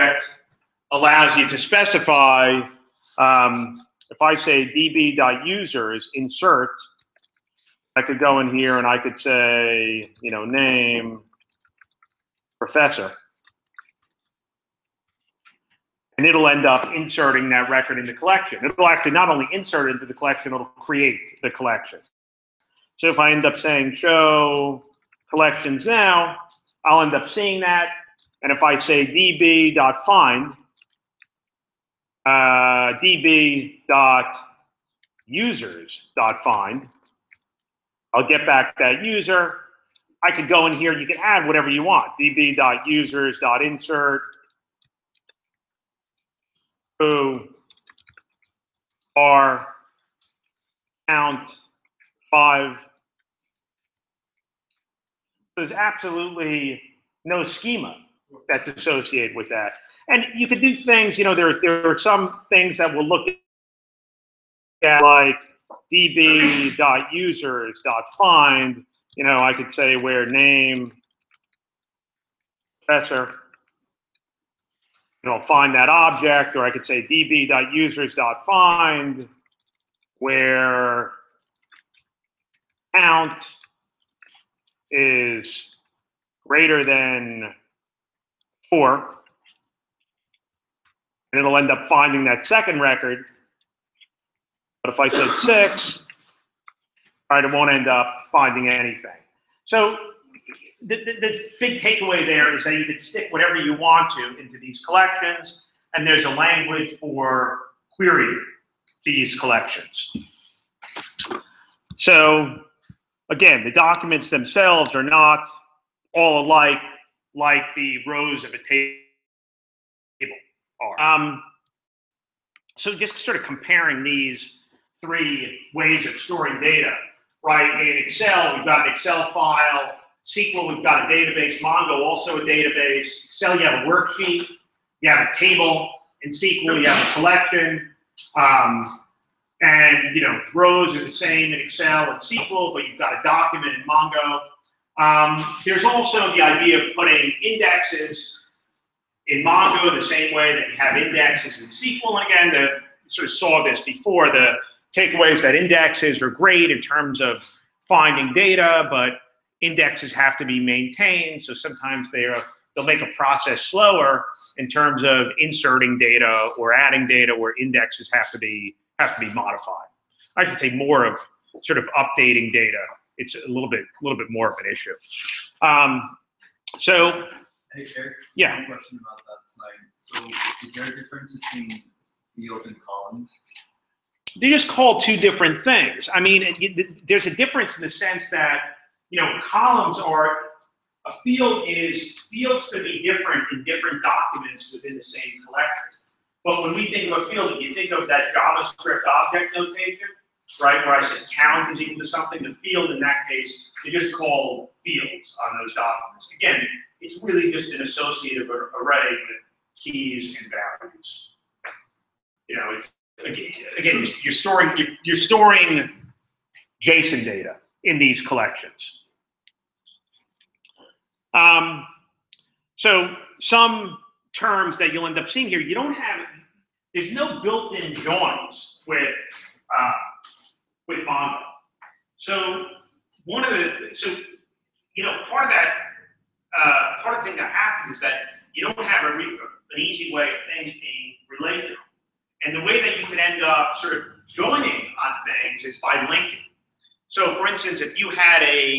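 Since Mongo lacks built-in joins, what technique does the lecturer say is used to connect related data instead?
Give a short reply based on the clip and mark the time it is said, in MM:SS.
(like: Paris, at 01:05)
linking, at 04:06.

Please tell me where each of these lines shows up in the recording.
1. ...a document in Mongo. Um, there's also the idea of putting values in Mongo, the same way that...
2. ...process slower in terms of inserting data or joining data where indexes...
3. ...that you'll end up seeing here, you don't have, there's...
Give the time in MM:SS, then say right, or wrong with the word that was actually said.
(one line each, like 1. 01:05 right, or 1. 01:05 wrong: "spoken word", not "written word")
1. 02:23 wrong: "indexes", not "values"
2. 02:43 wrong: "adding", not "joining"
3. 03:44 right.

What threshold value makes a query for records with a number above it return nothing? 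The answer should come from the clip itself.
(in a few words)
6.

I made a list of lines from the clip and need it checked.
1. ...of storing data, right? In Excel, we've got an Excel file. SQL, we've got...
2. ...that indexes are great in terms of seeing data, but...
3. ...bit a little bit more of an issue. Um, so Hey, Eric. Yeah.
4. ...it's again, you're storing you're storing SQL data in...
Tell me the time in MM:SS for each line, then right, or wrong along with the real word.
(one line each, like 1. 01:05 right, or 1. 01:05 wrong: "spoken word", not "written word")
1. 02:06 right
2. 02:35 wrong: "finding", not "seeing"
3. 02:53 right
4. 03:32 wrong: "JSON", not "SQL".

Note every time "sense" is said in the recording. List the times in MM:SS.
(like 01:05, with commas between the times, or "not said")
03:07.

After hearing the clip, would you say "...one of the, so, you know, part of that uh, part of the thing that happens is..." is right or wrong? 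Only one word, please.
right.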